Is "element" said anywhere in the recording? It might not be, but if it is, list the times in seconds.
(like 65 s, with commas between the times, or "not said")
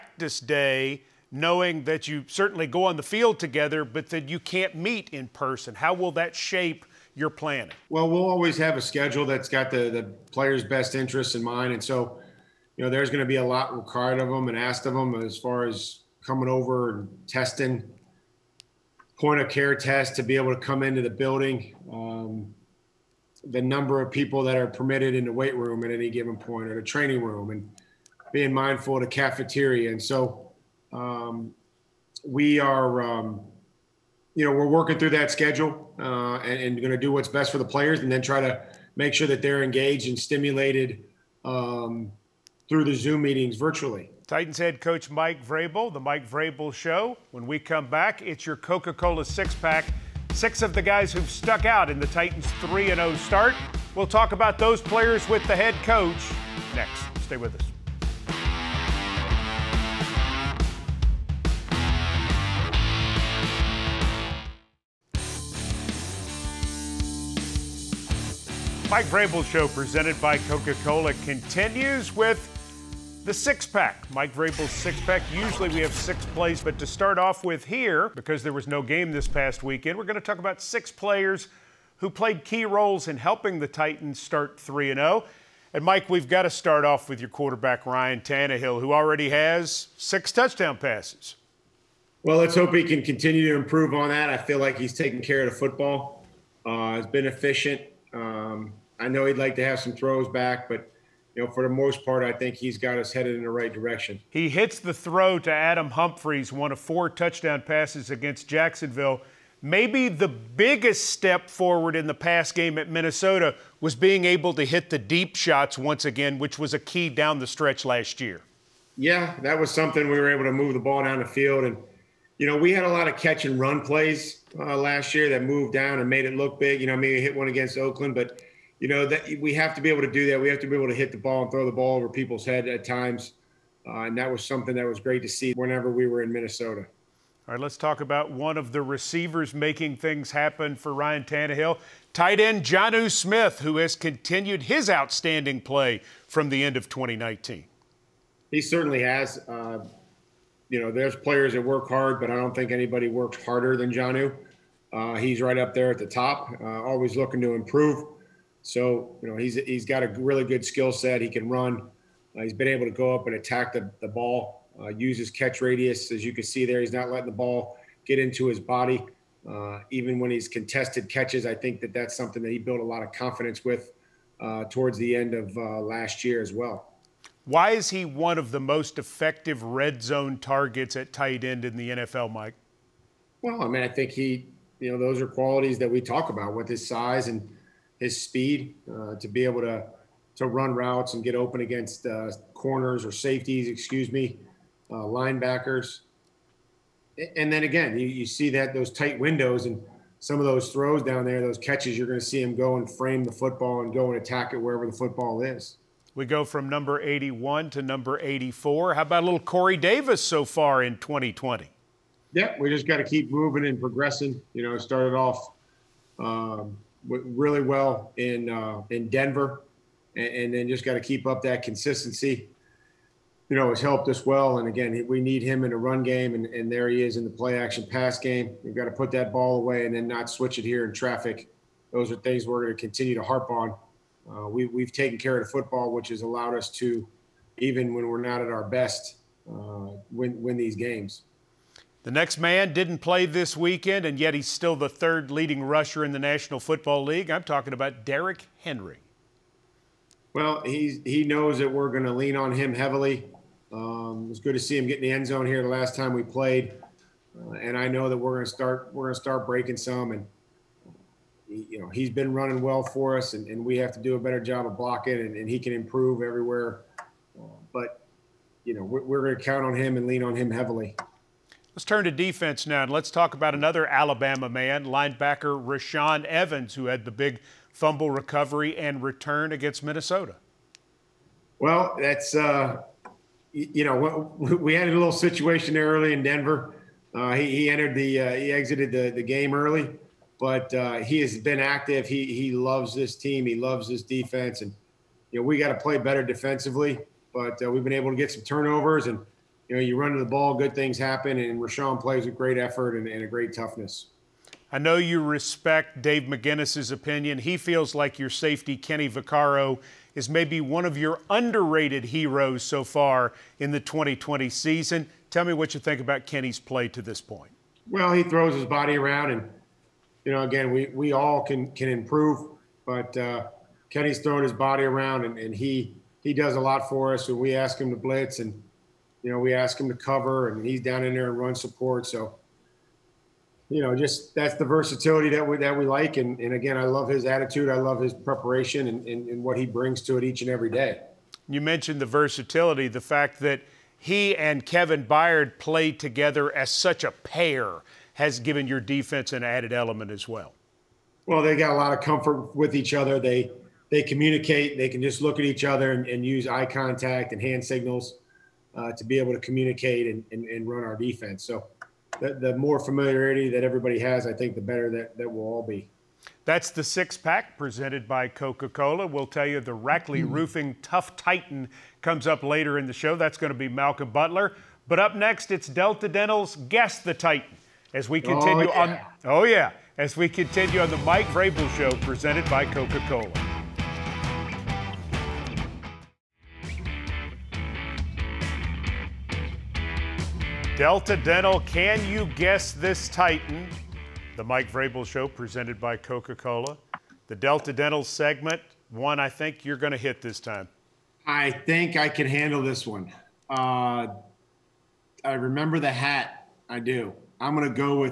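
349 s.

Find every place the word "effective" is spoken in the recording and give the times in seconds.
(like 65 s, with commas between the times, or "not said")
178 s.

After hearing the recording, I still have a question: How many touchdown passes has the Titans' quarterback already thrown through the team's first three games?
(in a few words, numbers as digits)
6.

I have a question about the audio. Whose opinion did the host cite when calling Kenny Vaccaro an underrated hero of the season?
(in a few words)
Dave McGinnis.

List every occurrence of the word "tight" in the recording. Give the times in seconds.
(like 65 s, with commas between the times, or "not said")
142 s, 181 s, 198 s.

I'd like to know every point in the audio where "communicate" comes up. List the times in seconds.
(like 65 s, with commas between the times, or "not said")
354 s, 359 s.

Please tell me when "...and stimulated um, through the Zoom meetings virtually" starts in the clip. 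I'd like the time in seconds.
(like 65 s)
40 s.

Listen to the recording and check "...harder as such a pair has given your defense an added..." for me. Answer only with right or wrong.
wrong.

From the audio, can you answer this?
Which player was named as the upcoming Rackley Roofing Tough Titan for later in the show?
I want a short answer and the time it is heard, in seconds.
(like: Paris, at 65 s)
Malcolm Butler, at 373 s.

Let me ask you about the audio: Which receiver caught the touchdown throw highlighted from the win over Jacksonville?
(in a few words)
Adam Humphries.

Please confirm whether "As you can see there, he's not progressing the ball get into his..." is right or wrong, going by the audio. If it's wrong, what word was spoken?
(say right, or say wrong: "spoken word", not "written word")
wrong: "letting", not "progressing".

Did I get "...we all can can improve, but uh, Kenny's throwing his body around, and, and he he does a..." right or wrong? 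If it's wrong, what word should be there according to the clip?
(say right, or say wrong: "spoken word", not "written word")
right.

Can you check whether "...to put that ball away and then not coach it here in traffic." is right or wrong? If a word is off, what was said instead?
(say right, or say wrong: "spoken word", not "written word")
wrong: "switch", not "coach".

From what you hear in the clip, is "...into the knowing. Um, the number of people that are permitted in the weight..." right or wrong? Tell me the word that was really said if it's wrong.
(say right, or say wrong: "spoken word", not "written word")
wrong: "building", not "knowing".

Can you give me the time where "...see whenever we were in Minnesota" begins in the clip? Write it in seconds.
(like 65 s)
135 s.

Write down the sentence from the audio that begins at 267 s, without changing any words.
Uh, but you know we're, we're going to count on him and lean on him heavily.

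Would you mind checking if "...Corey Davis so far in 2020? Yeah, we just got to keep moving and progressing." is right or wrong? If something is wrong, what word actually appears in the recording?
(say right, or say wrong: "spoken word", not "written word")
right.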